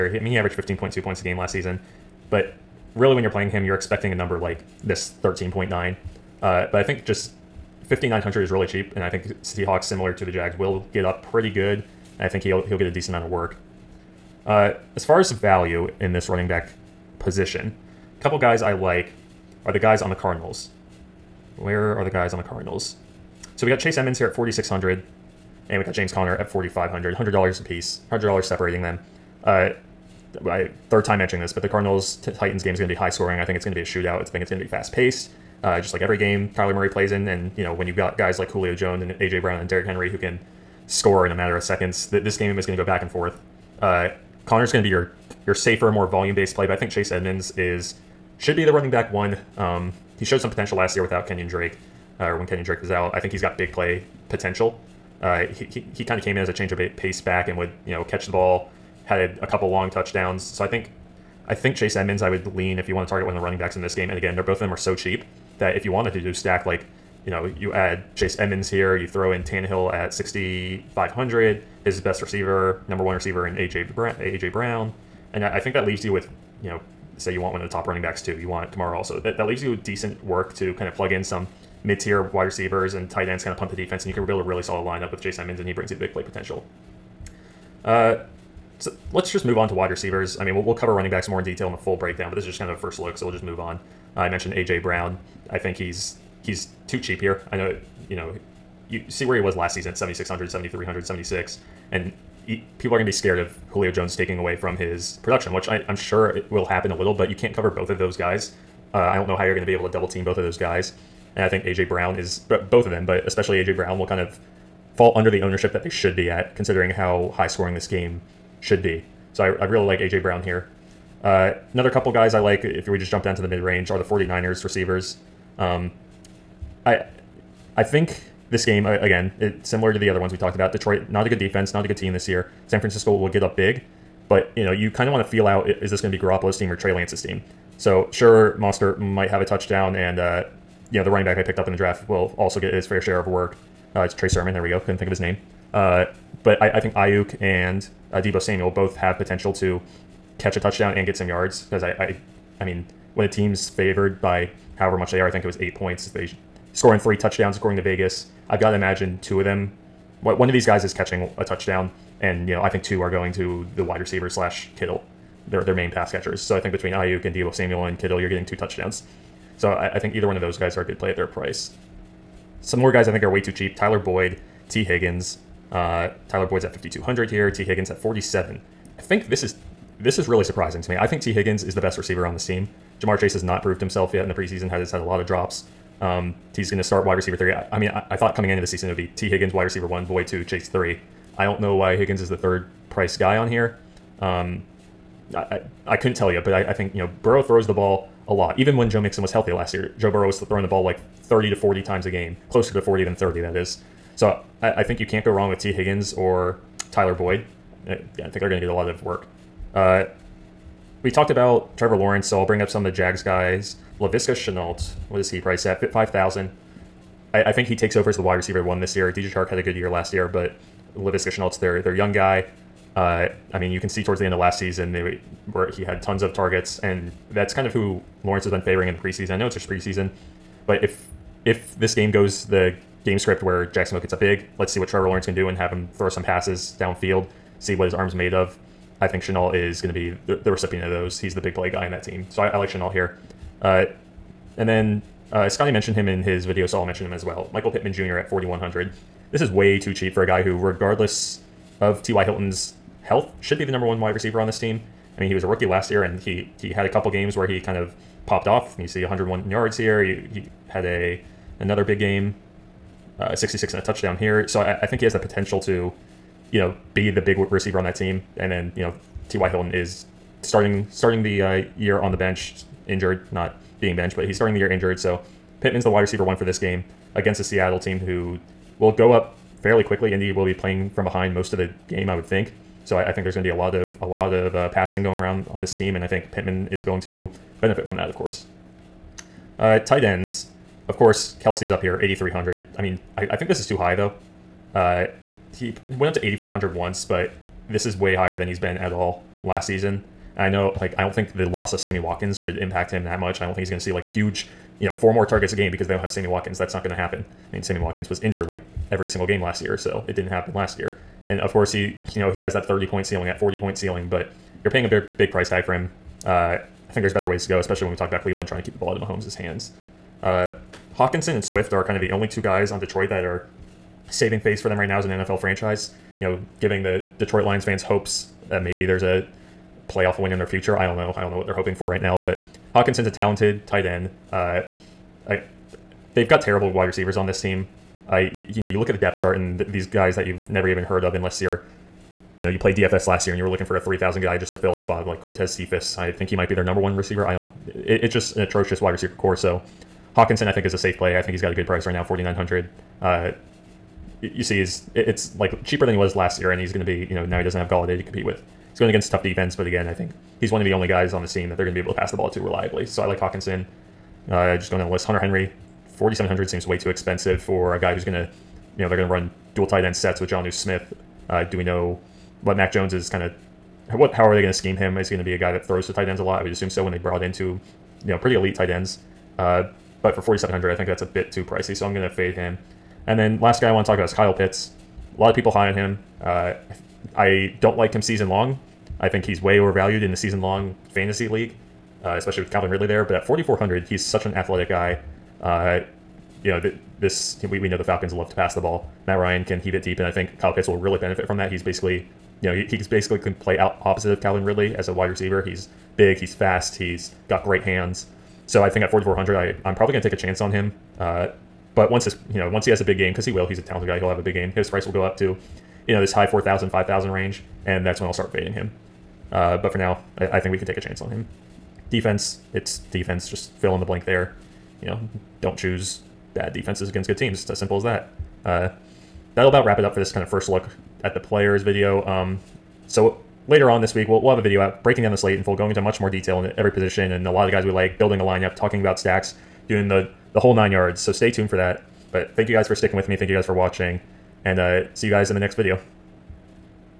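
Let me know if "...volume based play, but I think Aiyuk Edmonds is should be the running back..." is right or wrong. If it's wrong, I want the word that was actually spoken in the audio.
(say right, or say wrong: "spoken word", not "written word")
wrong: "Chase", not "Aiyuk".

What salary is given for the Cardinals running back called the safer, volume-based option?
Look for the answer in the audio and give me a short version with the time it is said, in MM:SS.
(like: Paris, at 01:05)
4,500, at 00:26.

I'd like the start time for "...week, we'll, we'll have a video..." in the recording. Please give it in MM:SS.
07:13.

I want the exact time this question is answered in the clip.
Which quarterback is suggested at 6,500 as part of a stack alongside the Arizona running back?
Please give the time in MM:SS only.
01:09.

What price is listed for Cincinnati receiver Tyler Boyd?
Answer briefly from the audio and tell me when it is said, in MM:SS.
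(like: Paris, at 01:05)
5,200, at 02:56.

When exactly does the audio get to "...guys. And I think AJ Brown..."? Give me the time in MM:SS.
01:50.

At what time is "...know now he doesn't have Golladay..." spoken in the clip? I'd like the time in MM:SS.
05:57.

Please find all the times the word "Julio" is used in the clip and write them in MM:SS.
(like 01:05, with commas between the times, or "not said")
00:38, 01:43.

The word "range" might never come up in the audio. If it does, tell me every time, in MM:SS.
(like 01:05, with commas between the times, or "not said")
02:03, 06:57.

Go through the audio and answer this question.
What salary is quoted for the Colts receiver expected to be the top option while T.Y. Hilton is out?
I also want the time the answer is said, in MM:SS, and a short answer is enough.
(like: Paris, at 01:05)
4,100, at 04:08.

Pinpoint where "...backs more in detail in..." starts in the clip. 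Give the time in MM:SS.
01:31.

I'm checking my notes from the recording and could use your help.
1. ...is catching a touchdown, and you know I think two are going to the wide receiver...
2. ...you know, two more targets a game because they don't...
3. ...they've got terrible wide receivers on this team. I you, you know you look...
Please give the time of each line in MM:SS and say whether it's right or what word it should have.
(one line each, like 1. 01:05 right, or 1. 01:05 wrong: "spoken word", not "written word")
1. 02:40 right
2. 05:04 wrong: "four", not "two"
3. 05:36 right.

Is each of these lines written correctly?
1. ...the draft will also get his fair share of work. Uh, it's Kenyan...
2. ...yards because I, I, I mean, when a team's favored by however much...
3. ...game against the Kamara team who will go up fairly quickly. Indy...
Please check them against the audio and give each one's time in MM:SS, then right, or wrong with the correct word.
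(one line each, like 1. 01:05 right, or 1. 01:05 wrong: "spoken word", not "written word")
1. 02:21 wrong: "Trey", not "Kenyan"
2. 02:31 right
3. 04:36 wrong: "Seattle", not "Kamara".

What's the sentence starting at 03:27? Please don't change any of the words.
I, think they're going to get a lot of work.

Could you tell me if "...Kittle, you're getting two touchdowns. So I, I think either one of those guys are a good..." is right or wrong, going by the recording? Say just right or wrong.
right.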